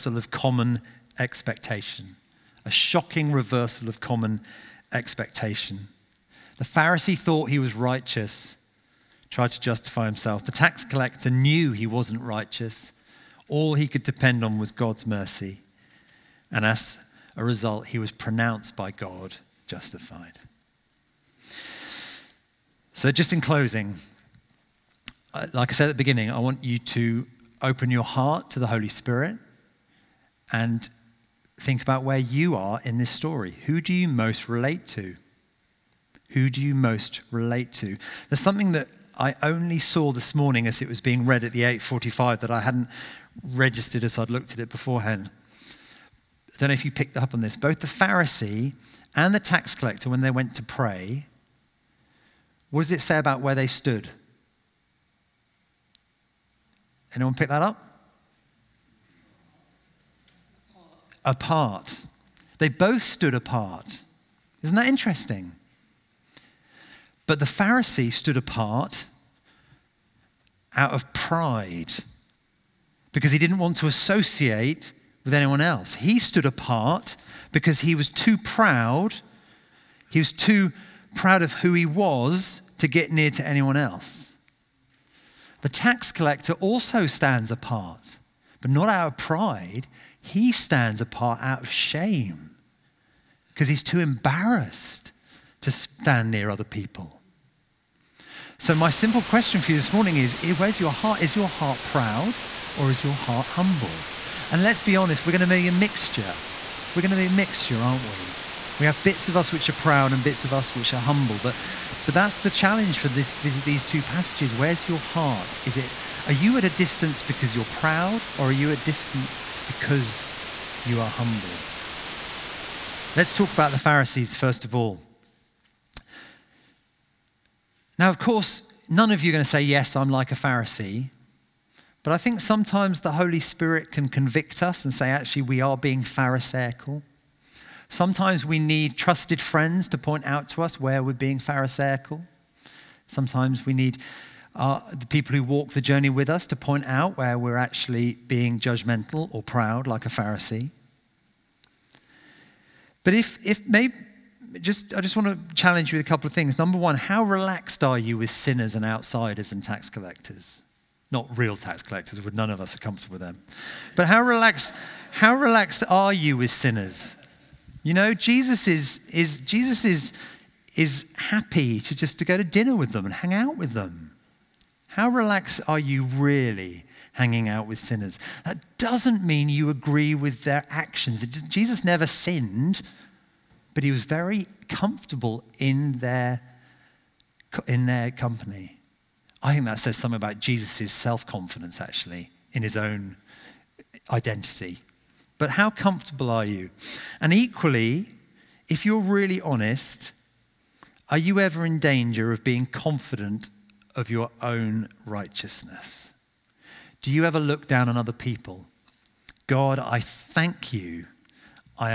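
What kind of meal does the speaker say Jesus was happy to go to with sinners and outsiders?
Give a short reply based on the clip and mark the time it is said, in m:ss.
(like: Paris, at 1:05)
dinner, at 2:52.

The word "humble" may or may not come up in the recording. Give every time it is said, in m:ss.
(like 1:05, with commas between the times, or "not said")
1:43, 1:51, 2:01.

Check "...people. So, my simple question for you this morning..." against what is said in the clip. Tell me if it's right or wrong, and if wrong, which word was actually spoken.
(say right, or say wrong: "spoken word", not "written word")
right.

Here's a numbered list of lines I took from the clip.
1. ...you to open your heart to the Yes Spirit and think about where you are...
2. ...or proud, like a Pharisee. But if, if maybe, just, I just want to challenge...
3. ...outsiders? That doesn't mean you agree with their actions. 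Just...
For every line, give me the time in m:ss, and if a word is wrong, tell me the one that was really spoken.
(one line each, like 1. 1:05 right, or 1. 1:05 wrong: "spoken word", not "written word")
1. 0:26 wrong: "Holy", not "Yes"
2. 2:29 right
3. 2:57 wrong: "sinners", not "outsiders".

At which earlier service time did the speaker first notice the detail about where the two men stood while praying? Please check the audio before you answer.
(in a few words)
8:45.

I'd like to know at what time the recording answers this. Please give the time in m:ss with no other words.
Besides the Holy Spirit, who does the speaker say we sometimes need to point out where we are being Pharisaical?
2:18.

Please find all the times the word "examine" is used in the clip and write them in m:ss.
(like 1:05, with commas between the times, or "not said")
not said.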